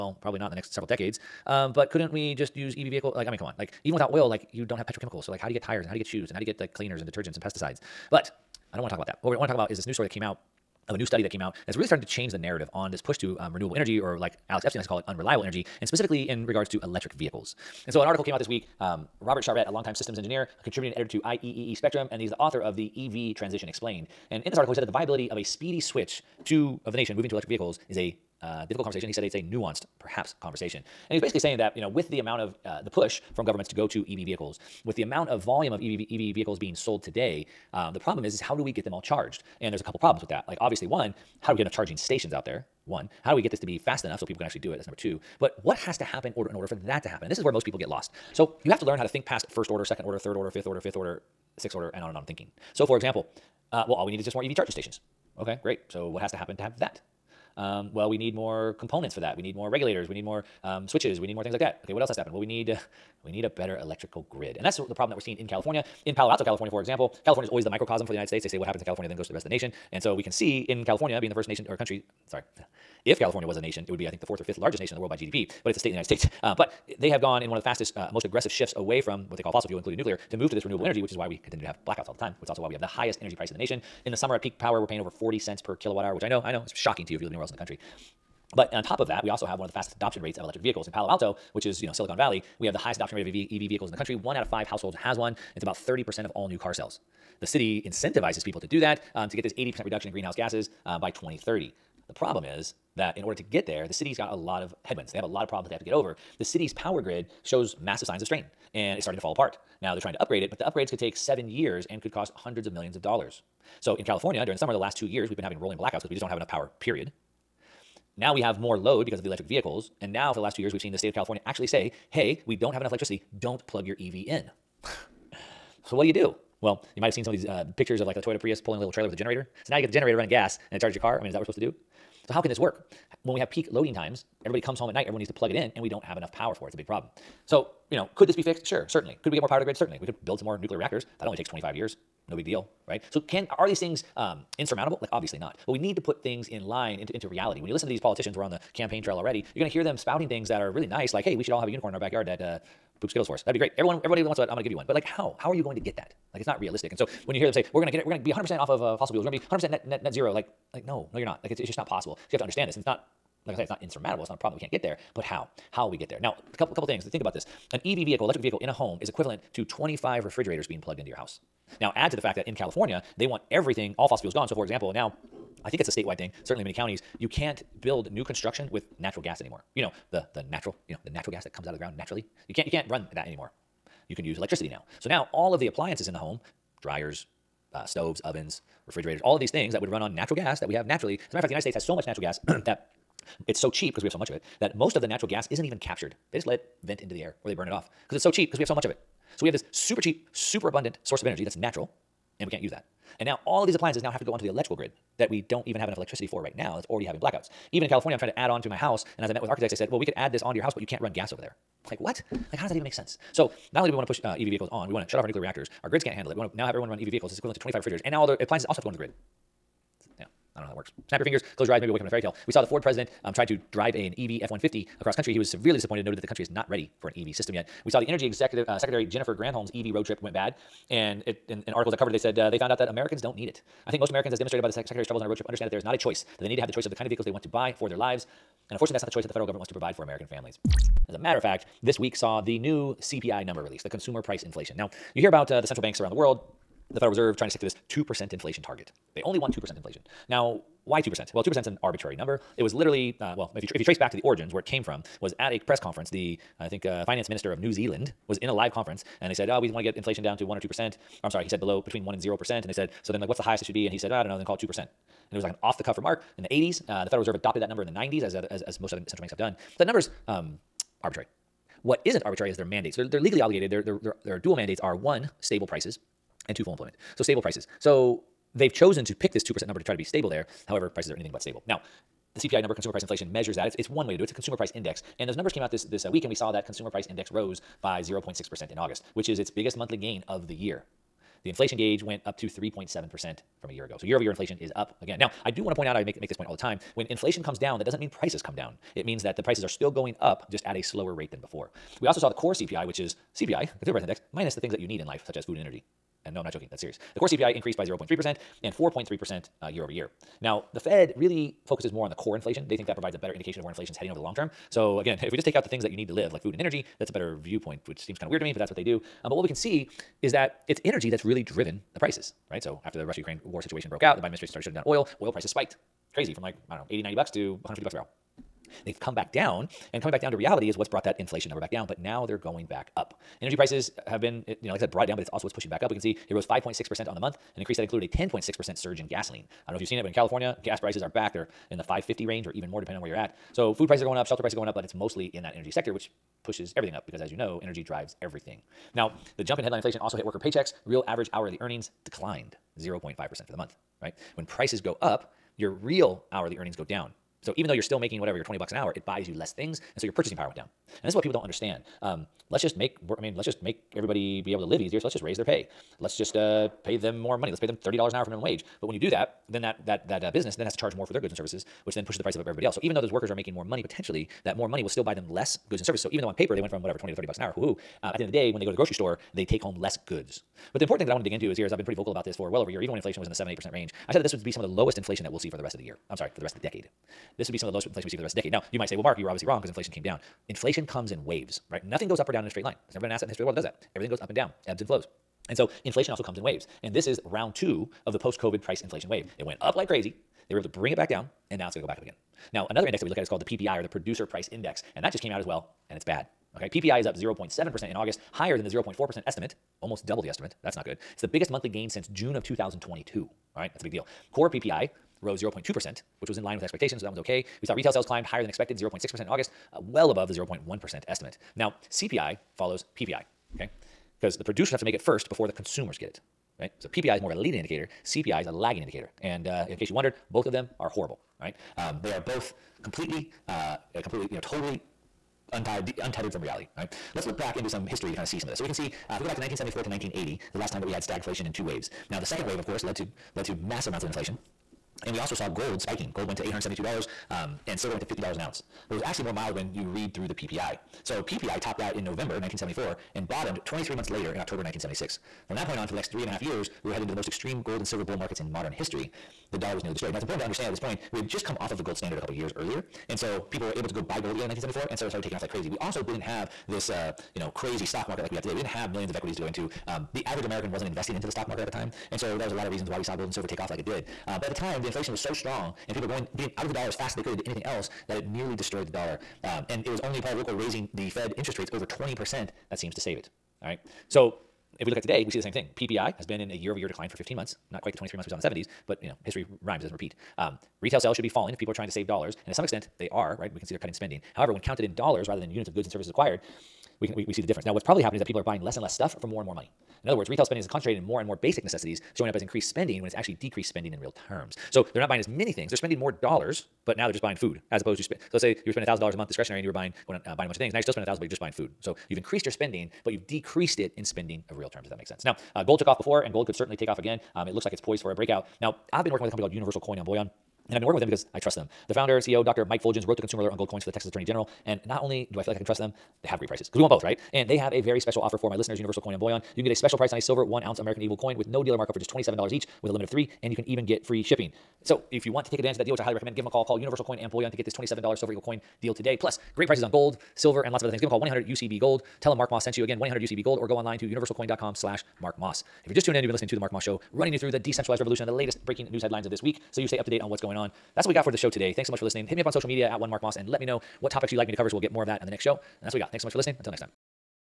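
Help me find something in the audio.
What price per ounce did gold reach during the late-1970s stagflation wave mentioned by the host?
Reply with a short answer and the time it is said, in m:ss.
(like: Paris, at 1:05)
$872, at 7:26.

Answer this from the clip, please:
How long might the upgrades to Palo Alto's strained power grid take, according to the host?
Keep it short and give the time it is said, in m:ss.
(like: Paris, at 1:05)
7 years, at 1:51.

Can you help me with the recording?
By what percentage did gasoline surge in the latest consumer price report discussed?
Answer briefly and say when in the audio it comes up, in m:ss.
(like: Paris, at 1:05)
10.6%, at 5:38.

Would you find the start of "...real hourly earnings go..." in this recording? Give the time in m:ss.
5:55.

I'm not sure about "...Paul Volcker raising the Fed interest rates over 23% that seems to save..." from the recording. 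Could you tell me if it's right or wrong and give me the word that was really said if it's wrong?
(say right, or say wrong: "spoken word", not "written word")
wrong: "20", not "23".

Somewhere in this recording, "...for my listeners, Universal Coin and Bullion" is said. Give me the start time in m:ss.
8:48.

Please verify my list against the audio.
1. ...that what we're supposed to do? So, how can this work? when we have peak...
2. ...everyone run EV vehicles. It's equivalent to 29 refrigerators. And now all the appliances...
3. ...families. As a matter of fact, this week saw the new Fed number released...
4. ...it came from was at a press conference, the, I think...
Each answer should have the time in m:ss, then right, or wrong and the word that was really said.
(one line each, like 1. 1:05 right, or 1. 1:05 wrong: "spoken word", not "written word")
1. 2:11 right
2. 3:36 wrong: "25", not "29"
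3. 4:00 wrong: "CPI", not "Fed"
4. 4:14 right.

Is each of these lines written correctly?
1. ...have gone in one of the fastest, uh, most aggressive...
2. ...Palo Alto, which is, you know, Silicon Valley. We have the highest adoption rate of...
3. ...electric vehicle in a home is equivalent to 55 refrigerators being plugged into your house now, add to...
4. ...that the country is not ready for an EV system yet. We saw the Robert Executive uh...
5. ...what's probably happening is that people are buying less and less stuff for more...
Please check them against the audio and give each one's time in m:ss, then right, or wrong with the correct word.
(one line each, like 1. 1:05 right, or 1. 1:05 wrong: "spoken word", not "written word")
1. 1:17 right
2. 1:30 right
3. 2:48 wrong: "25", not "55"
4. 3:46 wrong: "Energy", not "Robert"
5. 8:17 right.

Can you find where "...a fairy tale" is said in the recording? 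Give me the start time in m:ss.
3:42.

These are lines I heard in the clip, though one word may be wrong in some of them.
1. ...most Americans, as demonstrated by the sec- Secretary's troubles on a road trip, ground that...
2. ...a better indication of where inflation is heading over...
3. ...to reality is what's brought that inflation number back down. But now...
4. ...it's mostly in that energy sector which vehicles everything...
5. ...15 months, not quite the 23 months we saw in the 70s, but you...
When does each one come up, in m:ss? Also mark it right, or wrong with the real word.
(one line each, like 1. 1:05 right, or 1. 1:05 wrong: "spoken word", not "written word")
1. 3:53 wrong: "understand", not "ground"
2. 5:13 right
3. 5:30 right
4. 5:44 wrong: "pushes", not "vehicles"
5. 8:07 right.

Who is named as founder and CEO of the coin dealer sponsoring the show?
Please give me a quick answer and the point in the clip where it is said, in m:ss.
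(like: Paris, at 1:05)
Mike Fuljenz, at 8:42.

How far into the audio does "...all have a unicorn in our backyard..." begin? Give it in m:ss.
2:31.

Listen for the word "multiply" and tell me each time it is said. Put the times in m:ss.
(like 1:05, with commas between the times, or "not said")
not said.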